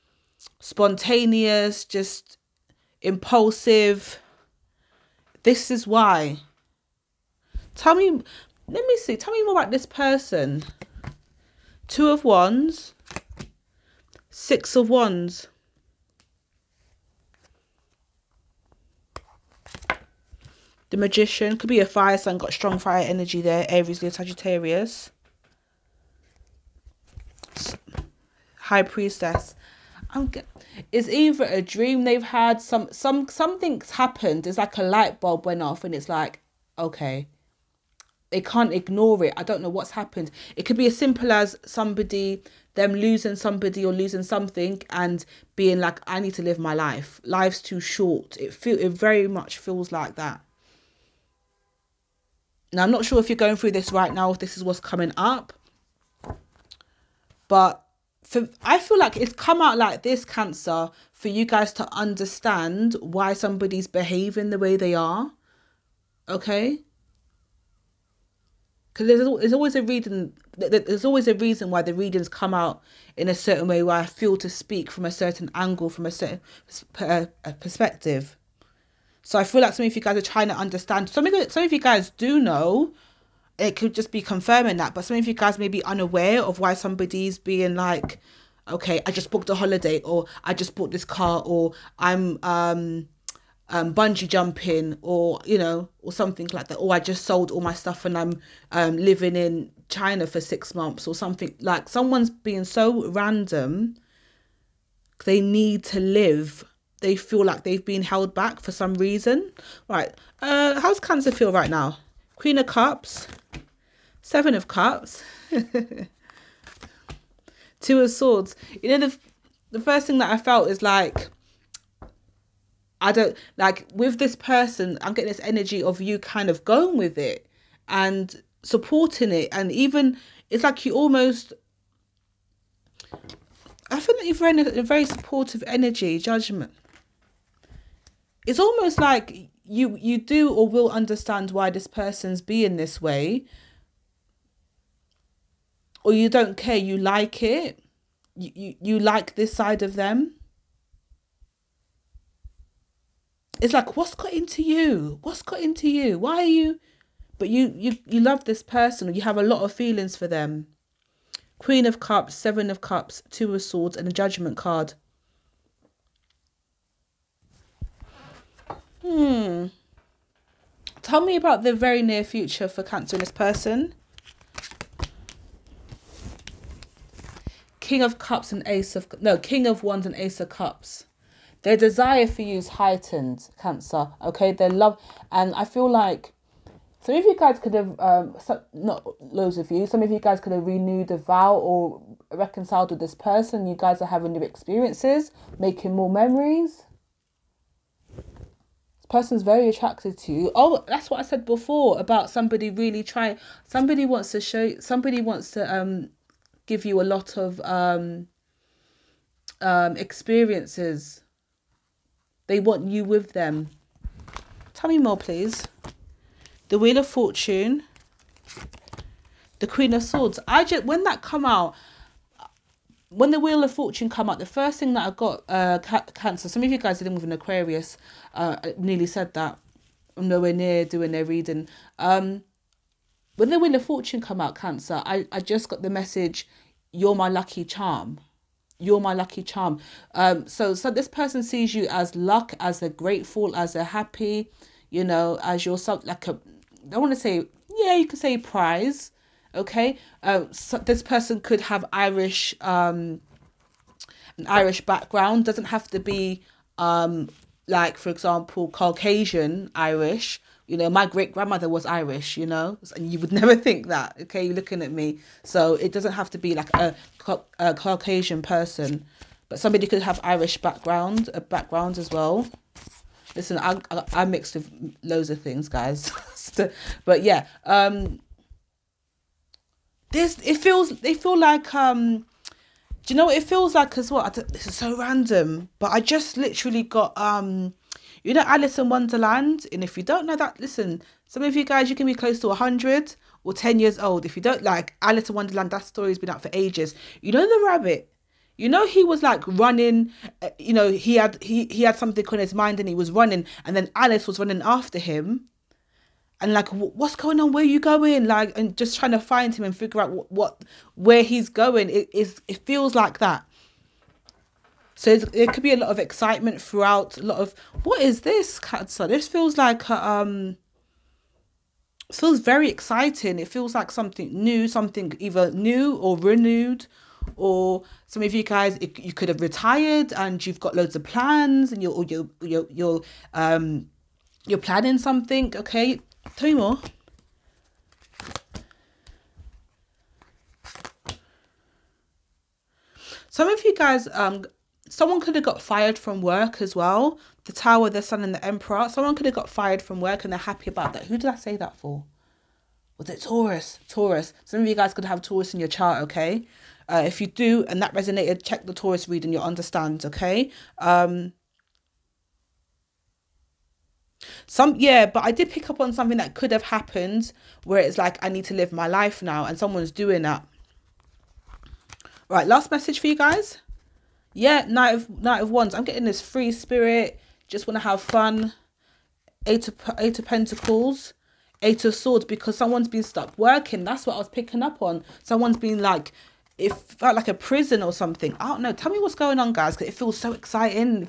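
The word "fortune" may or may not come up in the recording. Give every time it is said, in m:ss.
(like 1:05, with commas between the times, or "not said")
3:37, 3:43, 3:53.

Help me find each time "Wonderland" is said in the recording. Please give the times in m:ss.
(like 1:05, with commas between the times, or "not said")
4:48, 4:55.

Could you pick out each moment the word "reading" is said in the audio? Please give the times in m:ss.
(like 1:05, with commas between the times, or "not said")
1:11, 3:51, 5:59.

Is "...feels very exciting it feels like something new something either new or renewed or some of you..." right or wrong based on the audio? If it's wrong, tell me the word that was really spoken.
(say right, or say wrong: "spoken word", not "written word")
right.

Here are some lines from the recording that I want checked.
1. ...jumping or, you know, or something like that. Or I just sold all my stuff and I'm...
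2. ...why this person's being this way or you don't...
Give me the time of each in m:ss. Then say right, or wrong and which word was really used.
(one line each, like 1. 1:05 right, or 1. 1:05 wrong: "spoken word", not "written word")
1. 1:34 right
2. 2:21 right.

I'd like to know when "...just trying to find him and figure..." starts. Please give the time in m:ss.
5:08.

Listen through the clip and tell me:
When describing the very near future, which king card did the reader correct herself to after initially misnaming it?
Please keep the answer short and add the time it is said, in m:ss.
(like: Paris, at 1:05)
King of Wands, at 2:59.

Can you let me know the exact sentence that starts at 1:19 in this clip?
So I feel like some of you guys are trying to understand.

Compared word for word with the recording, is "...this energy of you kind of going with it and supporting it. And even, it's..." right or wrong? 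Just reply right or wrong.
right.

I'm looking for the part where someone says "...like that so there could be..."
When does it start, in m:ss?
5:12.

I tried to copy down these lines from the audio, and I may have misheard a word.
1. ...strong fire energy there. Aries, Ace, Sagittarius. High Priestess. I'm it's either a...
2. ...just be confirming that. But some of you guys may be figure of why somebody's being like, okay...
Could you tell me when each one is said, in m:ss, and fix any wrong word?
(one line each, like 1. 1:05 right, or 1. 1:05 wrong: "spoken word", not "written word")
1. 0:22 wrong: "Leo", not "Ace"
2. 1:23 wrong: "unaware", not "figure".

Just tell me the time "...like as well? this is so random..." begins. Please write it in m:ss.
4:43.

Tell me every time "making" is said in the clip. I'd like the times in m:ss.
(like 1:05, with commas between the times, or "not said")
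3:15.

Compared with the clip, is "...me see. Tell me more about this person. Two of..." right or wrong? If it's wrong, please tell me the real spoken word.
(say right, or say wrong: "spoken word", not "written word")
right.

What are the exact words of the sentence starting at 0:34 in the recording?
It's like a light bulb went off and it's like, okay.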